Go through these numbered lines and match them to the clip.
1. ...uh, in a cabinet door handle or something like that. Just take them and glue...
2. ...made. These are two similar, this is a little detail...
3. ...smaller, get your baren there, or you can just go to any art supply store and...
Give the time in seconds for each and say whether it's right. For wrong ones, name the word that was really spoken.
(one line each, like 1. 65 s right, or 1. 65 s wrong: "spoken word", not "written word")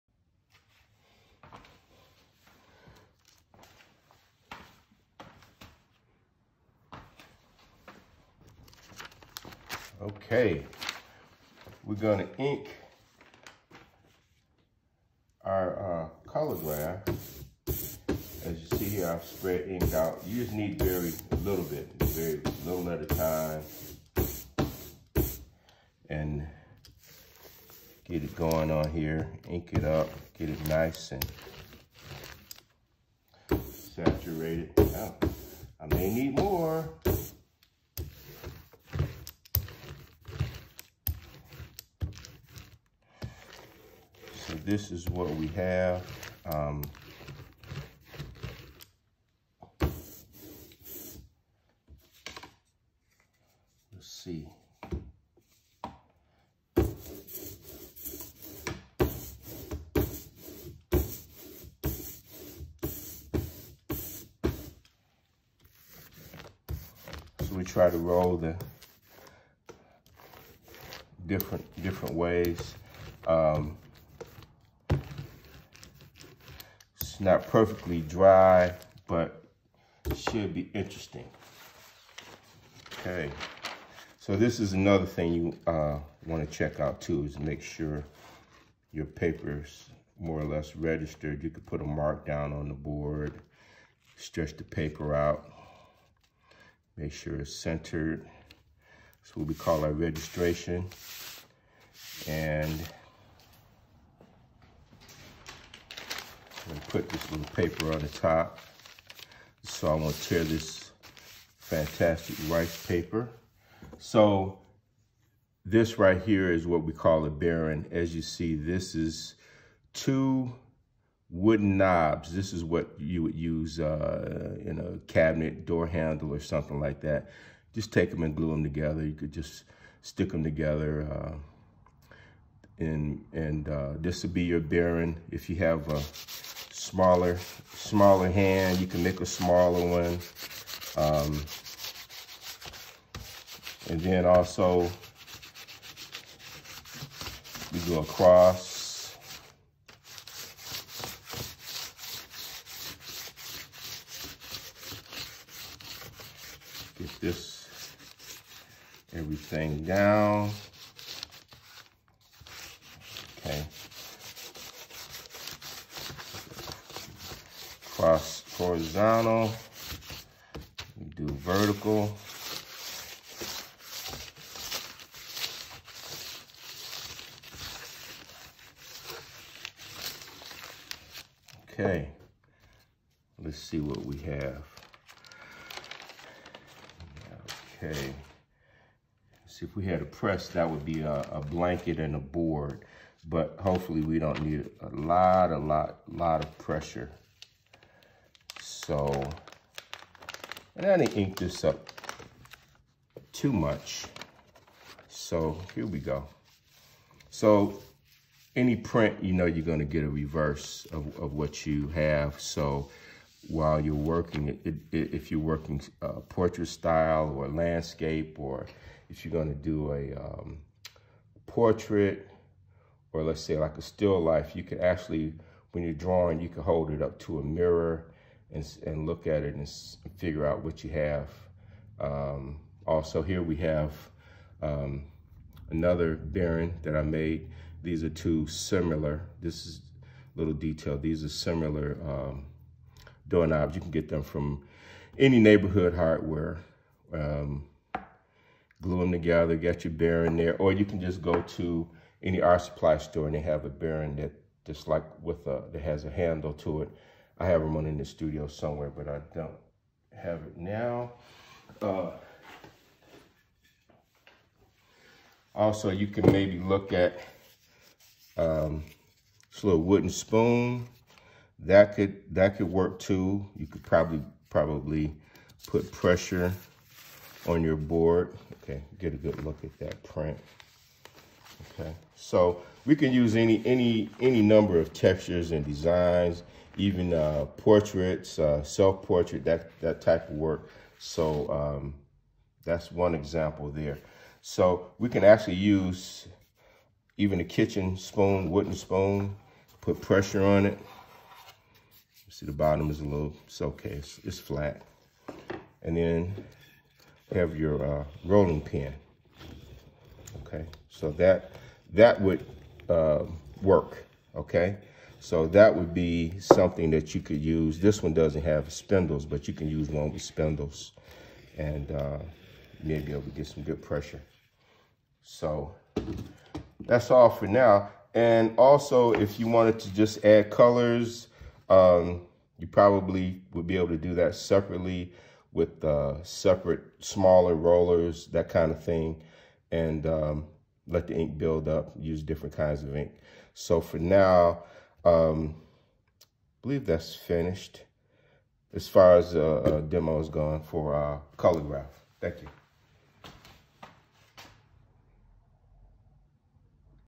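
1. 123 s right
2. 237 s right
3. 249 s wrong: "together", not "smaller".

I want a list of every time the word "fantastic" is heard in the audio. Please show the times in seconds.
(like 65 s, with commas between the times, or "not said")
111 s.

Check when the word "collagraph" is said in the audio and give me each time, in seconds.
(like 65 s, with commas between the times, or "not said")
16 s, 351 s.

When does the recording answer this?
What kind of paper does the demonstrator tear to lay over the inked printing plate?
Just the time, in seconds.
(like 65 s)
112 s.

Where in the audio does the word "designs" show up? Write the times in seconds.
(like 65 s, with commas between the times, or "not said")
285 s.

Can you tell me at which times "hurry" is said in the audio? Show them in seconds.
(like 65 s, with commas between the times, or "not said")
not said.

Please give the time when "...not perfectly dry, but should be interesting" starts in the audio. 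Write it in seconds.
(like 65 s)
77 s.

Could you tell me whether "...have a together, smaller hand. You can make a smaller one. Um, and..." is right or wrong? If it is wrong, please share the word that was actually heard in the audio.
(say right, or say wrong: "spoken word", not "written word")
wrong: "smaller", not "together".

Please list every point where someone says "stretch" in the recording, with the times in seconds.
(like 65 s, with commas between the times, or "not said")
94 s.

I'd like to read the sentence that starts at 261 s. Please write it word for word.
Uh, also, you can maybe look at um, this little wooden spoon.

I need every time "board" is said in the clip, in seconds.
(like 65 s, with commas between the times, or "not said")
92 s, 192 s, 277 s.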